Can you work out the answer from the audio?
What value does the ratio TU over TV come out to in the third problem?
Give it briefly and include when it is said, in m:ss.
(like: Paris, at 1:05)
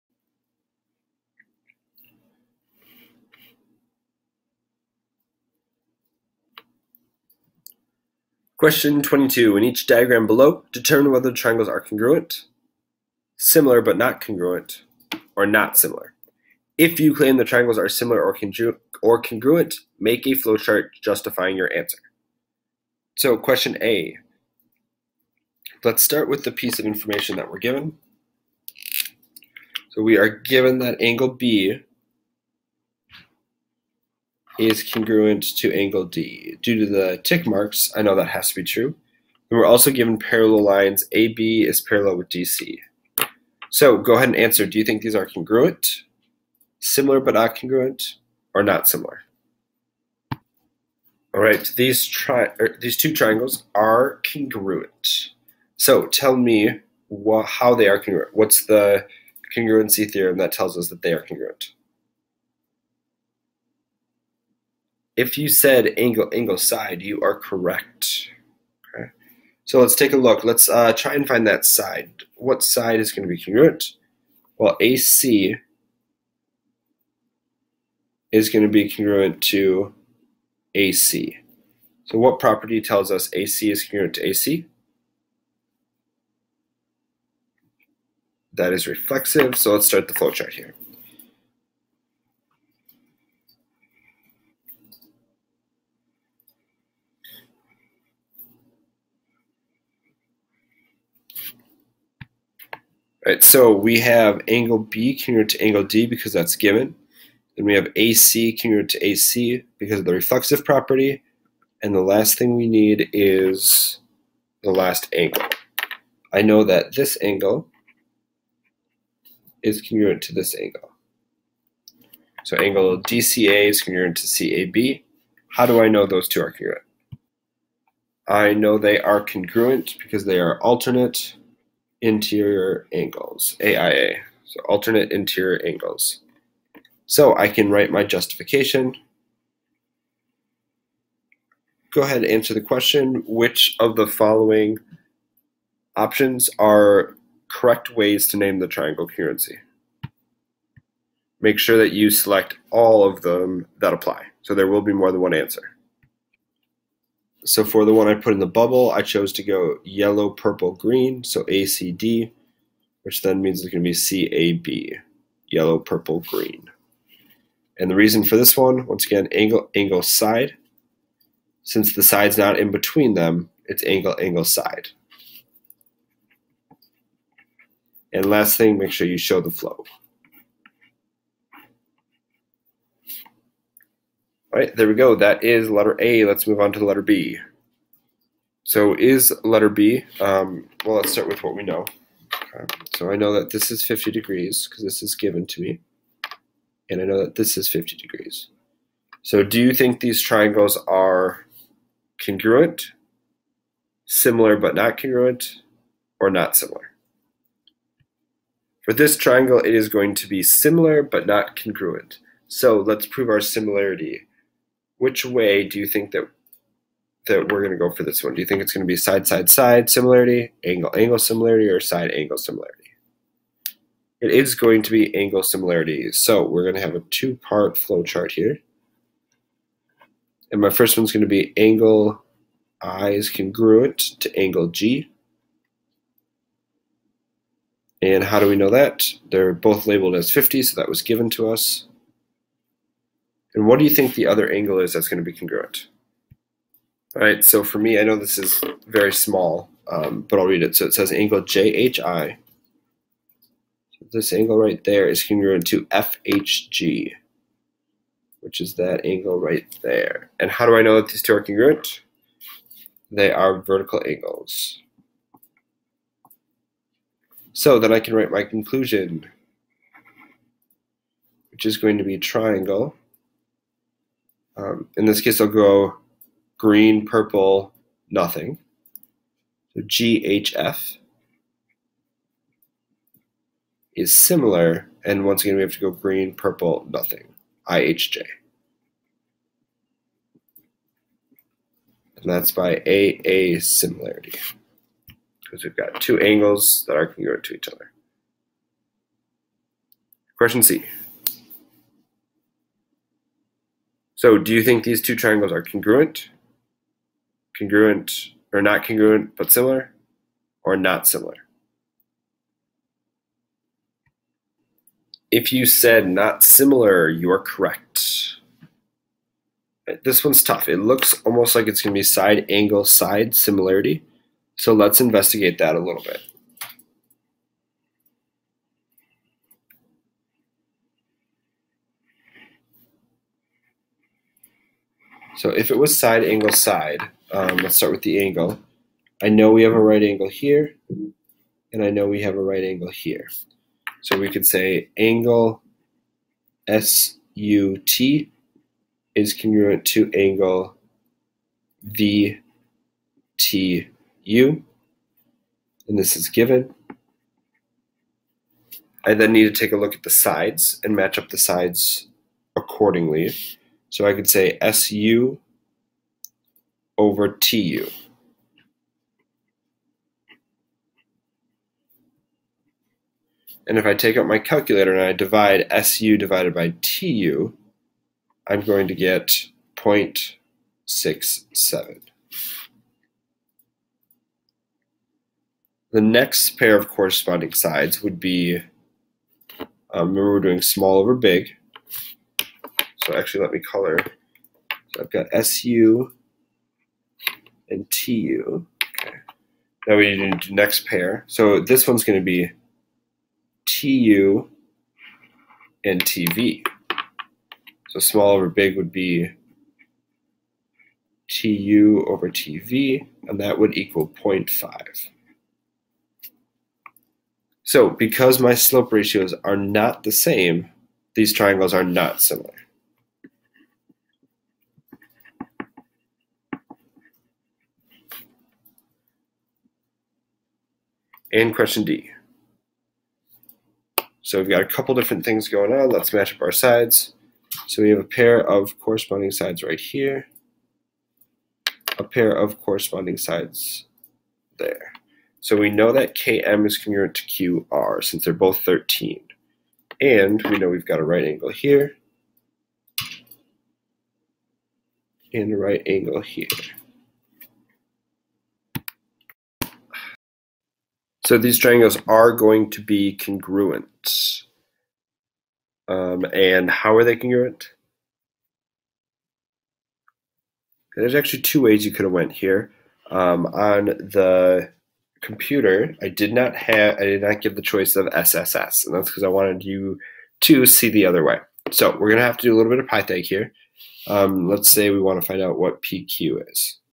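0.5, at 6:54.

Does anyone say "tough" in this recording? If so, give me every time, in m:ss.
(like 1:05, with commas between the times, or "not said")
5:20.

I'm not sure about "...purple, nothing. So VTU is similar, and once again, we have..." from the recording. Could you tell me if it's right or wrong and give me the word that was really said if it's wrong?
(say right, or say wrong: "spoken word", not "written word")
wrong: "GHF", not "VTU".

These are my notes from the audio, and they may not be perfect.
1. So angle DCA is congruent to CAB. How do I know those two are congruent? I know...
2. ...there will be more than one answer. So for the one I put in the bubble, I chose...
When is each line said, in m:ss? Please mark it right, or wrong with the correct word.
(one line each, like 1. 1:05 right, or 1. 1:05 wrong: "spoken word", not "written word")
1. 2:02 right
2. 2:34 right.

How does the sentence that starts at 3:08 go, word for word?
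So is letter B, um, well, let's start with what we know.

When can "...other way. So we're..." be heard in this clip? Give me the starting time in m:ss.
8:01.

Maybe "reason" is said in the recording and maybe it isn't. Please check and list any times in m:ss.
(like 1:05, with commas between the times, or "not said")
2:47.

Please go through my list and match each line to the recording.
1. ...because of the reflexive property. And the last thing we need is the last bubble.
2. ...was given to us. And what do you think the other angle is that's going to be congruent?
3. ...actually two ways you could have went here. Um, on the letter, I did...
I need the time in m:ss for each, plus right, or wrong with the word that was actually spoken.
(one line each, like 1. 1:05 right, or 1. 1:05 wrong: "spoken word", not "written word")
1. 1:49 wrong: "angle", not "bubble"
2. 4:00 right
3. 7:51 wrong: "computer", not "letter".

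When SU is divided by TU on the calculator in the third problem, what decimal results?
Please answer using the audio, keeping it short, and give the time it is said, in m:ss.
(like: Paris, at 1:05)
0.67, at 6:19.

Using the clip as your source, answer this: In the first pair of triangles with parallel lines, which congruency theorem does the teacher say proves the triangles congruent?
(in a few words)
angle-angle-side.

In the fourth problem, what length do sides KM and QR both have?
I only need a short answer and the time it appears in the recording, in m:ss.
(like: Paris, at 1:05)
13, at 7:28.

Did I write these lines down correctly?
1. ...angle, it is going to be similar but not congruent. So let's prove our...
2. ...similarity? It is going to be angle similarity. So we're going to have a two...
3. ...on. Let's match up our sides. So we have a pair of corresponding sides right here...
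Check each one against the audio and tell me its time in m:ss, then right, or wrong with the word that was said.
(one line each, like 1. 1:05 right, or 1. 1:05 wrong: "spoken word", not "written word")
1. 3:29 wrong: "triangle", not "angle"
2. 3:42 right
3. 7:15 right.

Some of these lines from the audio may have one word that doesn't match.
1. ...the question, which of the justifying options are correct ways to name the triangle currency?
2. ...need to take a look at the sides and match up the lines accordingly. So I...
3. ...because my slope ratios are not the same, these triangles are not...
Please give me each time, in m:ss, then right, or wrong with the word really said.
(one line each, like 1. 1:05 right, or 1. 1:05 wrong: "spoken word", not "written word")
1. 2:22 wrong: "following", not "justifying"
2. 5:59 wrong: "sides", not "lines"
3. 6:57 right.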